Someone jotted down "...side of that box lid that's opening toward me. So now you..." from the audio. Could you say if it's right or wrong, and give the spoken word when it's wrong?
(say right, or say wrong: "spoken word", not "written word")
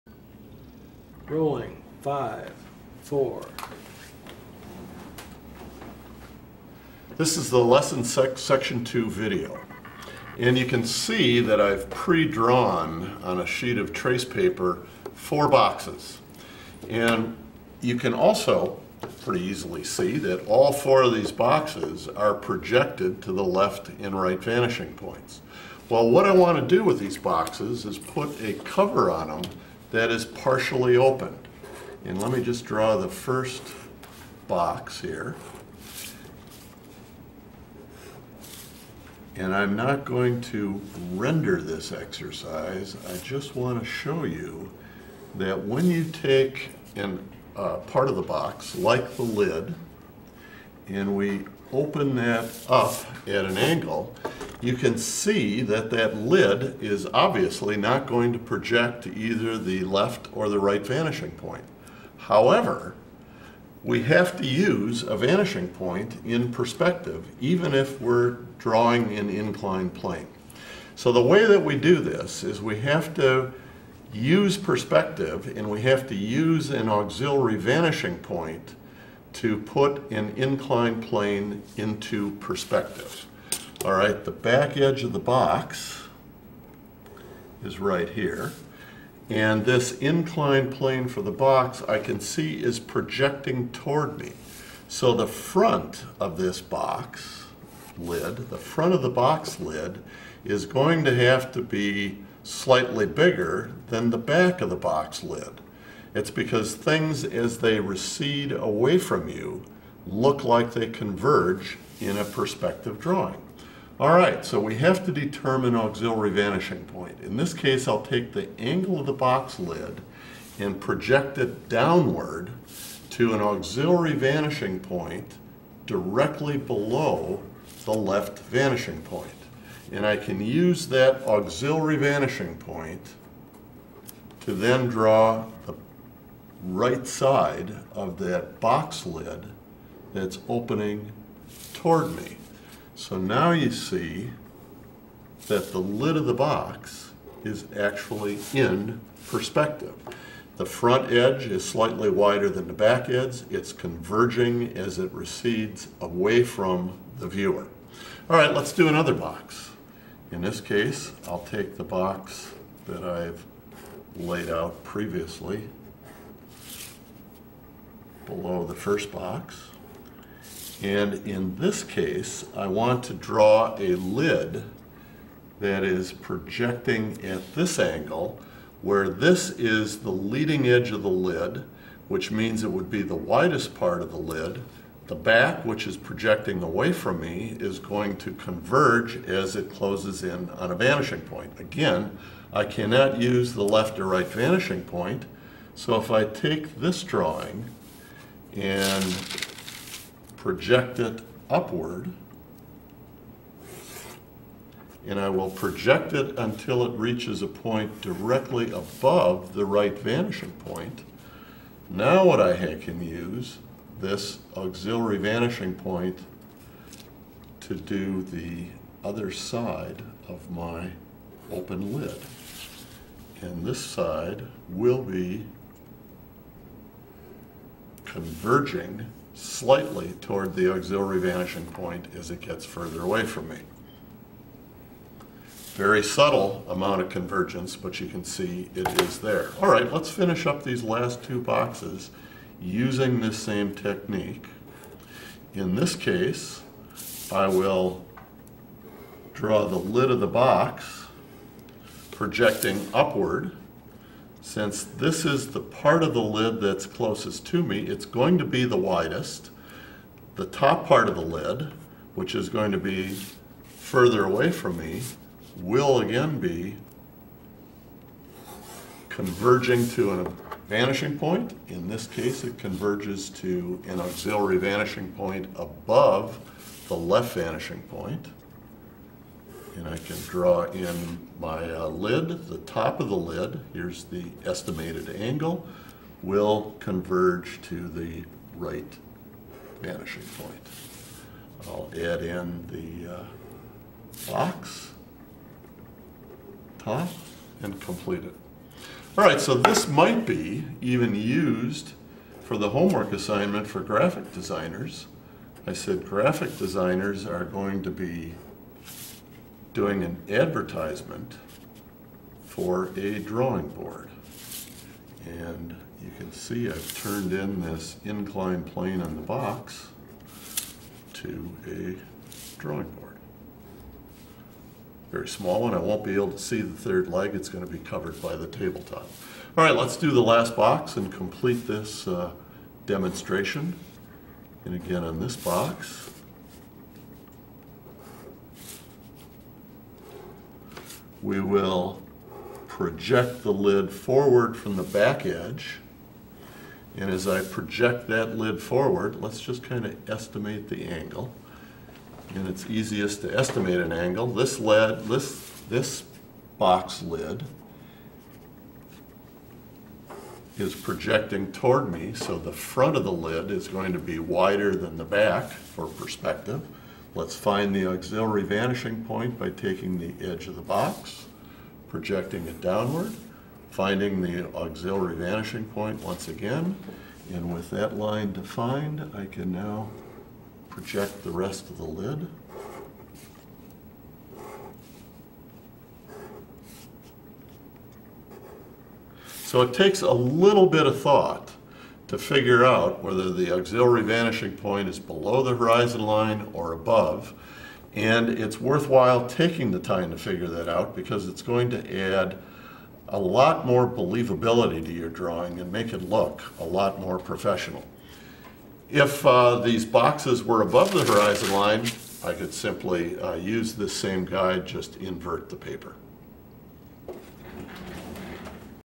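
right.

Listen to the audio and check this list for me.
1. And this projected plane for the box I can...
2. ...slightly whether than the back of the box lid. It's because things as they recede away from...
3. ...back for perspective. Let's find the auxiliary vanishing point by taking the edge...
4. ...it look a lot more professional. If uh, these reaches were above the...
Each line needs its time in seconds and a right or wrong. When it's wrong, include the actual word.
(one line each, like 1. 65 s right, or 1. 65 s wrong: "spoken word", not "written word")
1. 89 s wrong: "inclined", not "projected"
2. 102 s wrong: "bigger", not "whether"
3. 365 s right
4. 405 s wrong: "boxes", not "reaches".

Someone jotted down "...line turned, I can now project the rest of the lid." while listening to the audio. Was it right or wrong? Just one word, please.
wrong.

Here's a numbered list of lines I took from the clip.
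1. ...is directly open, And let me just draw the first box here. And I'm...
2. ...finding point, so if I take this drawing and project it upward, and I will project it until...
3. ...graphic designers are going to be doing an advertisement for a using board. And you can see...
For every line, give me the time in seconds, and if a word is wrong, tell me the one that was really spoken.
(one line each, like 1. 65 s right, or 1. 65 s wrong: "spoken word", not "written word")
1. 30 s wrong: "partially", not "directly"
2. 194 s wrong: "vanishing", not "finding"
3. 306 s wrong: "drawing", not "using".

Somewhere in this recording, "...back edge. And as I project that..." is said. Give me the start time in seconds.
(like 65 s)
344 s.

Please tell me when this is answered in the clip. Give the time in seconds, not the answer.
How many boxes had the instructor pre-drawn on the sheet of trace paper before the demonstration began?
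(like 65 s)
15 s.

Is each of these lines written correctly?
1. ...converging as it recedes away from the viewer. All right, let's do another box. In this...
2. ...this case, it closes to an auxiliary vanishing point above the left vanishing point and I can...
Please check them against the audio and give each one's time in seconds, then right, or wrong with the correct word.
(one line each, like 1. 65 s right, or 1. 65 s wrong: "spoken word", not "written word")
1. 153 s right
2. 271 s wrong: "converges", not "closes".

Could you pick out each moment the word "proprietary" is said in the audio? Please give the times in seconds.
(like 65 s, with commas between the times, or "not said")
not said.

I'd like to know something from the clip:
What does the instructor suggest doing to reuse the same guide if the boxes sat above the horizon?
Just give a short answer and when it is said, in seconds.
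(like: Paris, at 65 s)
invert the paper, at 414 s.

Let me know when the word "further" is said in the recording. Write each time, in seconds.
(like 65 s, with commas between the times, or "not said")
232 s, 263 s.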